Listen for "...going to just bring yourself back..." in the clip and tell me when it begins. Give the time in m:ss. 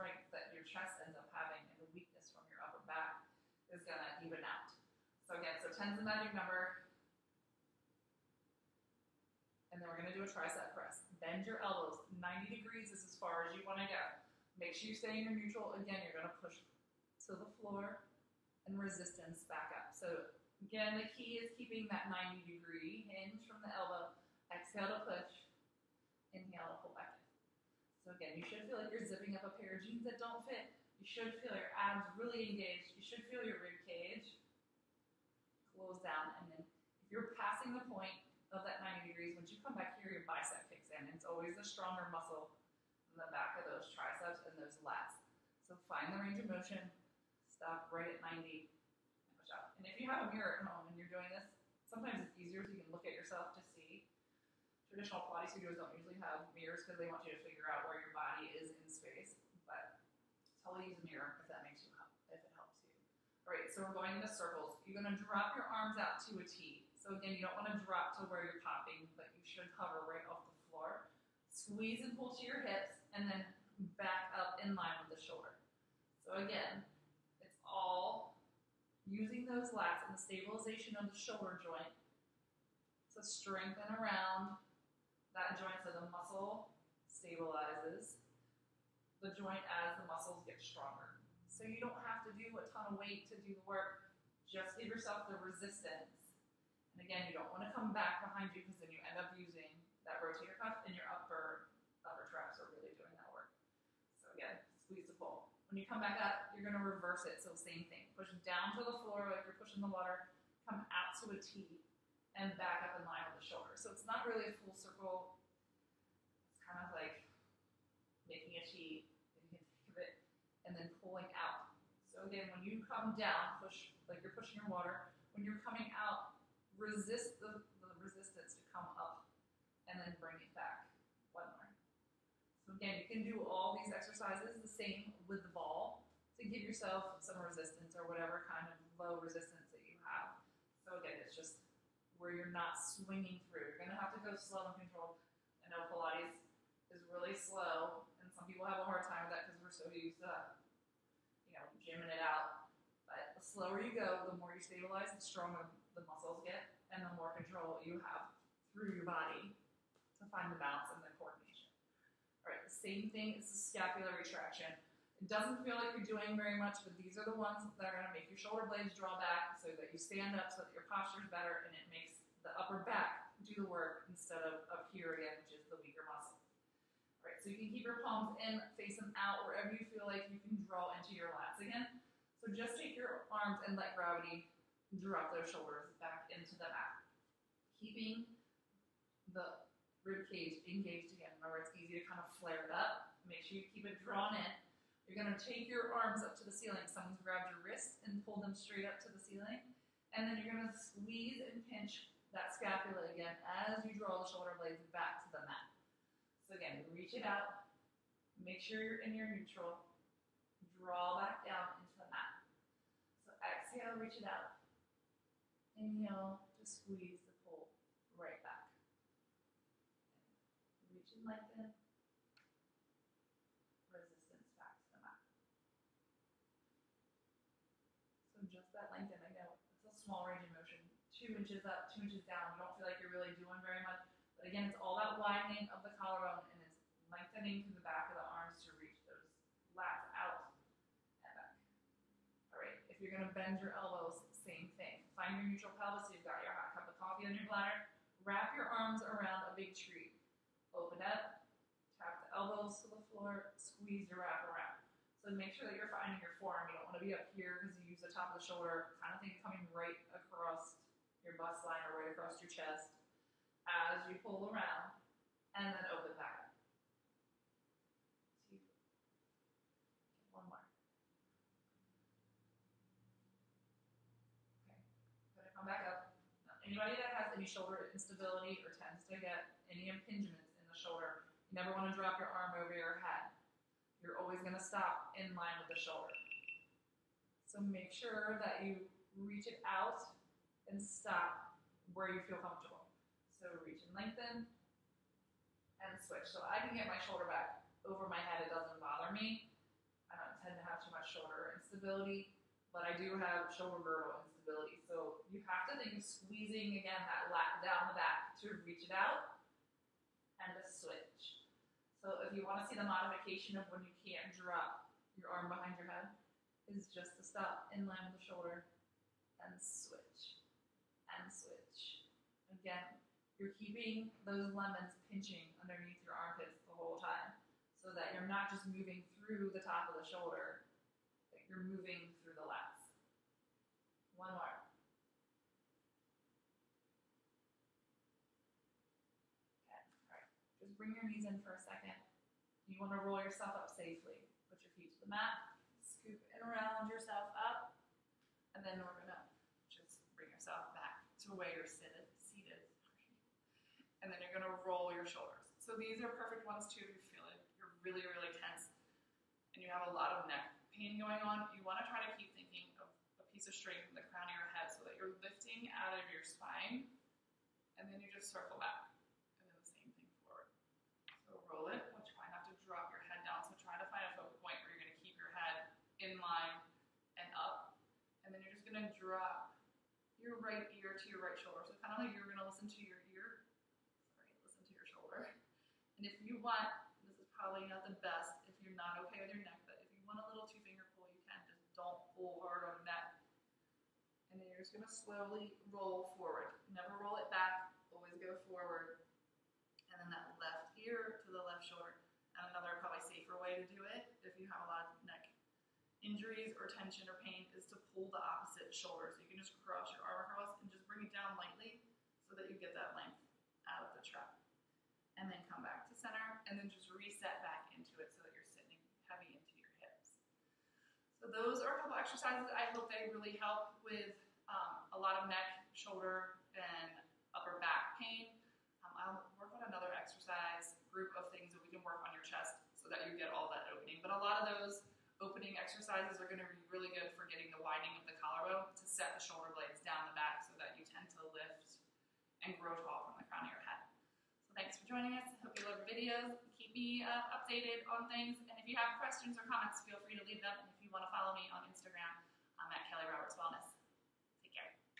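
5:48.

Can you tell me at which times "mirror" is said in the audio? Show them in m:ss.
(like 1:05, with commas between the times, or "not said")
0:50, 0:56, 1:01.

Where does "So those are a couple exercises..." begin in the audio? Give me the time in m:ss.
7:01.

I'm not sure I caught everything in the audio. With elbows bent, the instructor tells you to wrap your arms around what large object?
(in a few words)
A big tree.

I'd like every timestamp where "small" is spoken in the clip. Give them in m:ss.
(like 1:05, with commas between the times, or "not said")
3:50.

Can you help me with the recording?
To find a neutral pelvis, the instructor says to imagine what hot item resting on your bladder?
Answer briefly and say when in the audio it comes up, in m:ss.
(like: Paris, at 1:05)
Cup of coffee, at 4:06.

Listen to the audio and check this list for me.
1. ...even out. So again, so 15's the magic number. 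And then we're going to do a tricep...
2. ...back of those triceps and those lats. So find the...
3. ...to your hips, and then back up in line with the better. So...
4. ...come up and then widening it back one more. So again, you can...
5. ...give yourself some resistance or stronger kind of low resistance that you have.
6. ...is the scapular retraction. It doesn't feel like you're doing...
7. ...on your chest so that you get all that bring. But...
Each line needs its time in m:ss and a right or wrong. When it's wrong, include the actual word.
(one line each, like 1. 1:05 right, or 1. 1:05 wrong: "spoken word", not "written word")
1. 0:04 wrong: "10", not "15"
2. 0:43 right
3. 1:12 wrong: "shoulder", not "better"
4. 2:08 wrong: "bring", not "widening"
5. 2:16 wrong: "whatever", not "stronger"
6. 2:43 right
7. 7:12 wrong: "opening", not "bring".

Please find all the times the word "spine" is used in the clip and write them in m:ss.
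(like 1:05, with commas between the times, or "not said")
6:06.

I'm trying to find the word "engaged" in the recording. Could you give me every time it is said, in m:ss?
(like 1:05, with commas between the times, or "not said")
0:32, 3:10.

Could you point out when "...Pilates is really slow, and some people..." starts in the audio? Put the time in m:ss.
2:25.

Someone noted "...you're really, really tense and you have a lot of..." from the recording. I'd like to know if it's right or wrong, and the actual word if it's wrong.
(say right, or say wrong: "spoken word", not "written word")
right.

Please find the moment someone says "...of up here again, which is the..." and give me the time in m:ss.
2:54.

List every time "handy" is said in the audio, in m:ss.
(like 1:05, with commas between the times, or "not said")
not said.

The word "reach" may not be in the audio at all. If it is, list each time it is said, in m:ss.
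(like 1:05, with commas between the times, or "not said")
3:26, 3:33, 3:40, 3:58, 4:49, 4:53, 5:08.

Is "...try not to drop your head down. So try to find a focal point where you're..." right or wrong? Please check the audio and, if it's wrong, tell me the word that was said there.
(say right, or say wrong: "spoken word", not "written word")
right.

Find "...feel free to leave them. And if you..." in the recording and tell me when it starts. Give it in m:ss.
7:29.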